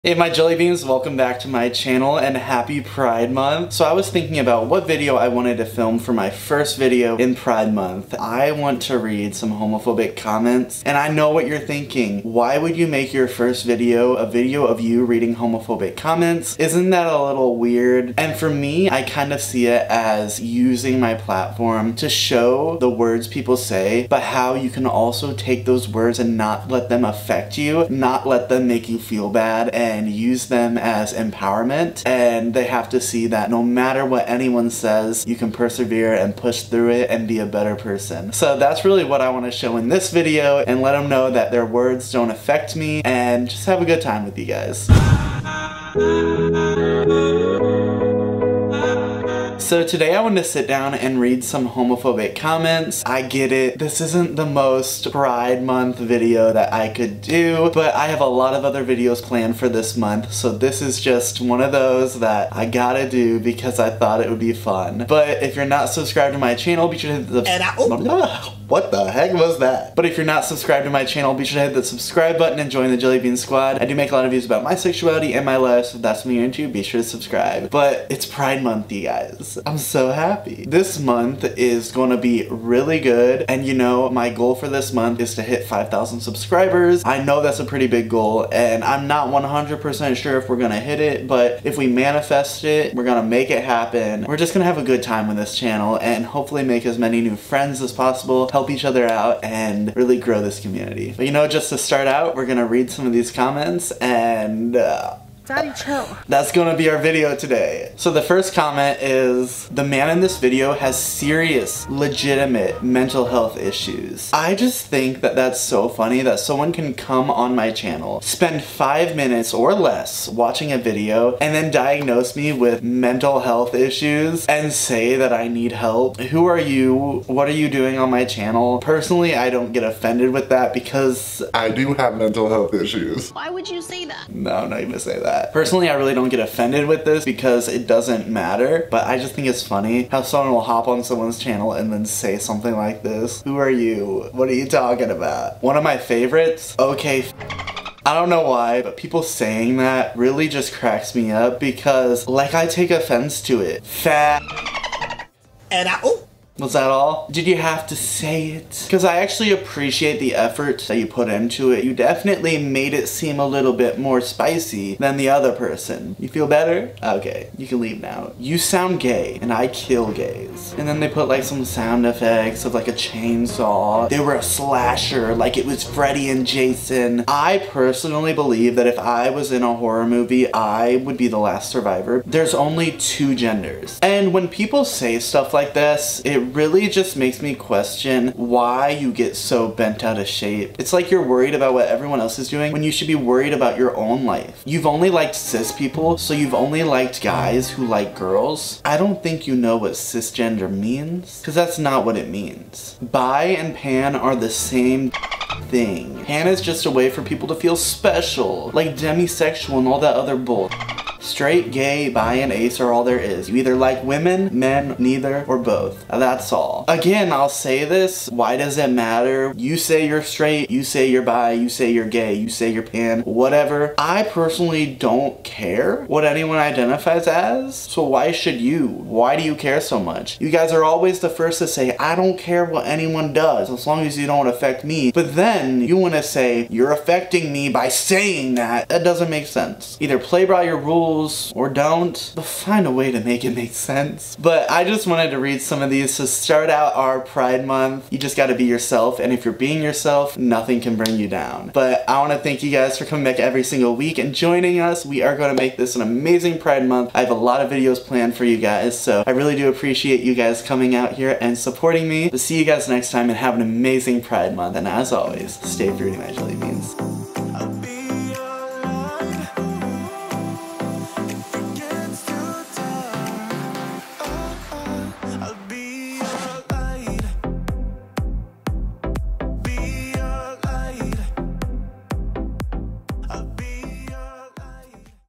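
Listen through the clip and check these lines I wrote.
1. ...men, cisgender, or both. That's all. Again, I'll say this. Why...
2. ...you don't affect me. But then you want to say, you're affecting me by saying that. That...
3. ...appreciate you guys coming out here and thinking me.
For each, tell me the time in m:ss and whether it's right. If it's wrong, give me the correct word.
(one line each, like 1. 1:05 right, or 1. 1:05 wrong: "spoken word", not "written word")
1. 3:34 wrong: "neither", not "cisgender"
2. 3:54 right
3. 4:19 wrong: "supporting", not "thinking".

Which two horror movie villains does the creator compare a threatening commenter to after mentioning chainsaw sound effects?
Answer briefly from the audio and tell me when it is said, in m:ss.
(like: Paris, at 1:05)
Freddy and Jason, at 2:55.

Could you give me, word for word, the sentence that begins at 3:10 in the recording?
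It's like you're worried about what everyone else is doing when you should be worried about your own life.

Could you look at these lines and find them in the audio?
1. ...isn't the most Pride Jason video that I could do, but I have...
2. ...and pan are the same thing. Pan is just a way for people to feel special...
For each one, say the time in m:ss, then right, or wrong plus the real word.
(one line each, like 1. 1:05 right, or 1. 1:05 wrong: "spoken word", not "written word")
1. 0:54 wrong: "Month", not "Jason"
2. 3:23 right.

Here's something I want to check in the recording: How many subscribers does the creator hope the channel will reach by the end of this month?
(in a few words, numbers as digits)
5000.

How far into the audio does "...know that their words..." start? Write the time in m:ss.
0:41.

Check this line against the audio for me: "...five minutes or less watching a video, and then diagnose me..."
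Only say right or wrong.
right.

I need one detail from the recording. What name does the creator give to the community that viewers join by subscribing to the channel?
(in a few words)
Jelly Bean Squad.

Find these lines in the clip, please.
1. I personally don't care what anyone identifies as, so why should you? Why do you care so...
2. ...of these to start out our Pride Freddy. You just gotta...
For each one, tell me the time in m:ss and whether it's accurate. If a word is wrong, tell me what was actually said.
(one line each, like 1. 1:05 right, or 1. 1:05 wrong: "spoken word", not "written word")
1. 3:43 right
2. 4:05 wrong: "Month", not "Freddy".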